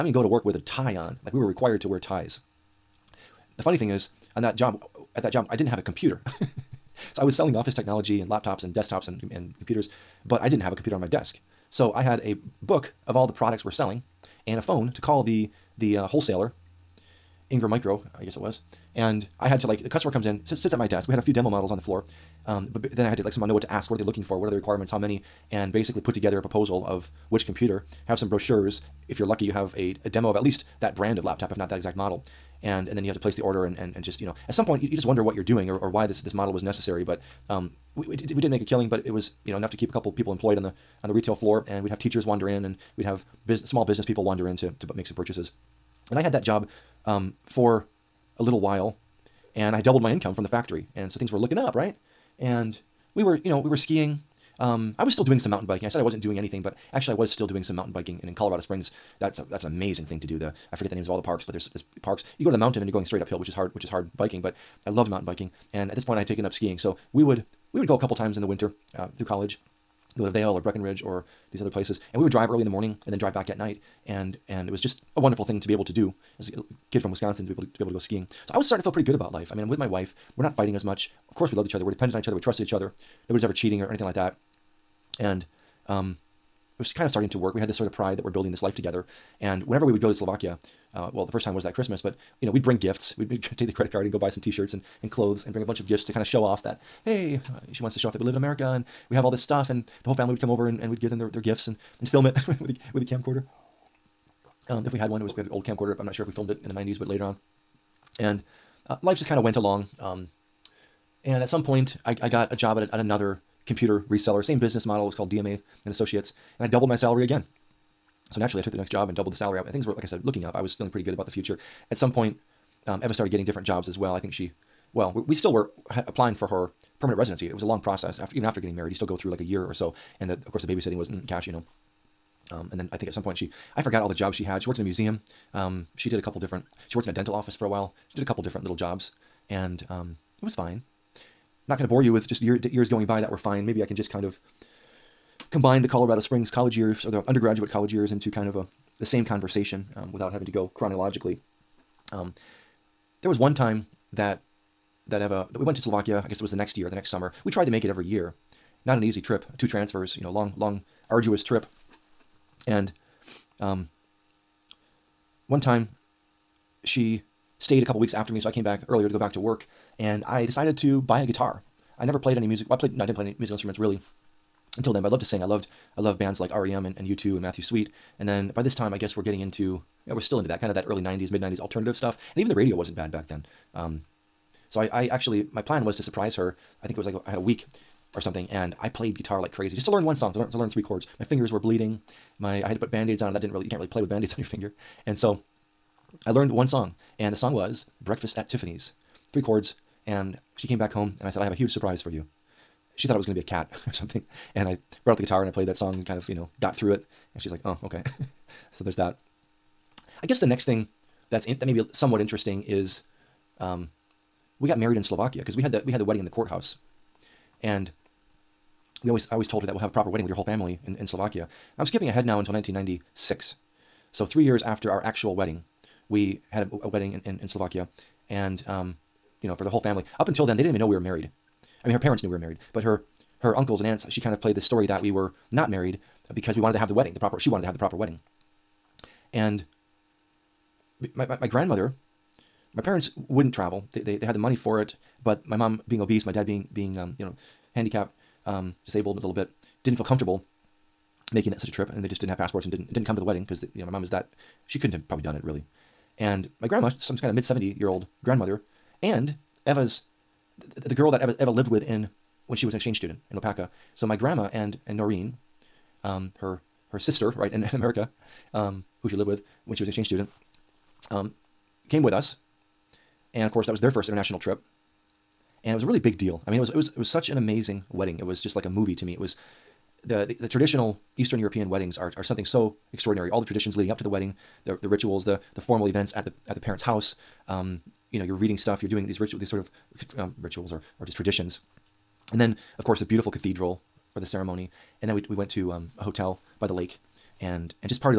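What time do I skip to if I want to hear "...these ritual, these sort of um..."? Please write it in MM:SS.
04:49.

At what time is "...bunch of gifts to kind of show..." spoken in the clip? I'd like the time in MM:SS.
01:35.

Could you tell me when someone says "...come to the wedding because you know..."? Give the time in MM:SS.
04:13.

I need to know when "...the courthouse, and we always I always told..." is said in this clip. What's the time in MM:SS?
03:36.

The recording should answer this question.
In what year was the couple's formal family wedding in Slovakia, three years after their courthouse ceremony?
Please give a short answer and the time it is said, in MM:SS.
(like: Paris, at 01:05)
1996, at 03:42.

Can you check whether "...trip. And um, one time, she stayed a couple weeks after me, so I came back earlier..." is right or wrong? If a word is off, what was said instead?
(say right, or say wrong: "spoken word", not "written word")
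right.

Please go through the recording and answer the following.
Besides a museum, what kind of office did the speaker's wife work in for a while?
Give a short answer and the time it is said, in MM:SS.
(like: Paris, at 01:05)
dental office, at 02:17.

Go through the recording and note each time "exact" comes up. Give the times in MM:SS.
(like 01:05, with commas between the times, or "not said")
00:31.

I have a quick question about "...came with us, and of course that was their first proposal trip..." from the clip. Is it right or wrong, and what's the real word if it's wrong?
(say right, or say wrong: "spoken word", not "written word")
wrong: "international", not "proposal".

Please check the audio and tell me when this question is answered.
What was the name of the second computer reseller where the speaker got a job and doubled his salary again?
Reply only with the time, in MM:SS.
01:55.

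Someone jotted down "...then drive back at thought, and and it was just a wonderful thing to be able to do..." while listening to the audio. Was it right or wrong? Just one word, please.
wrong.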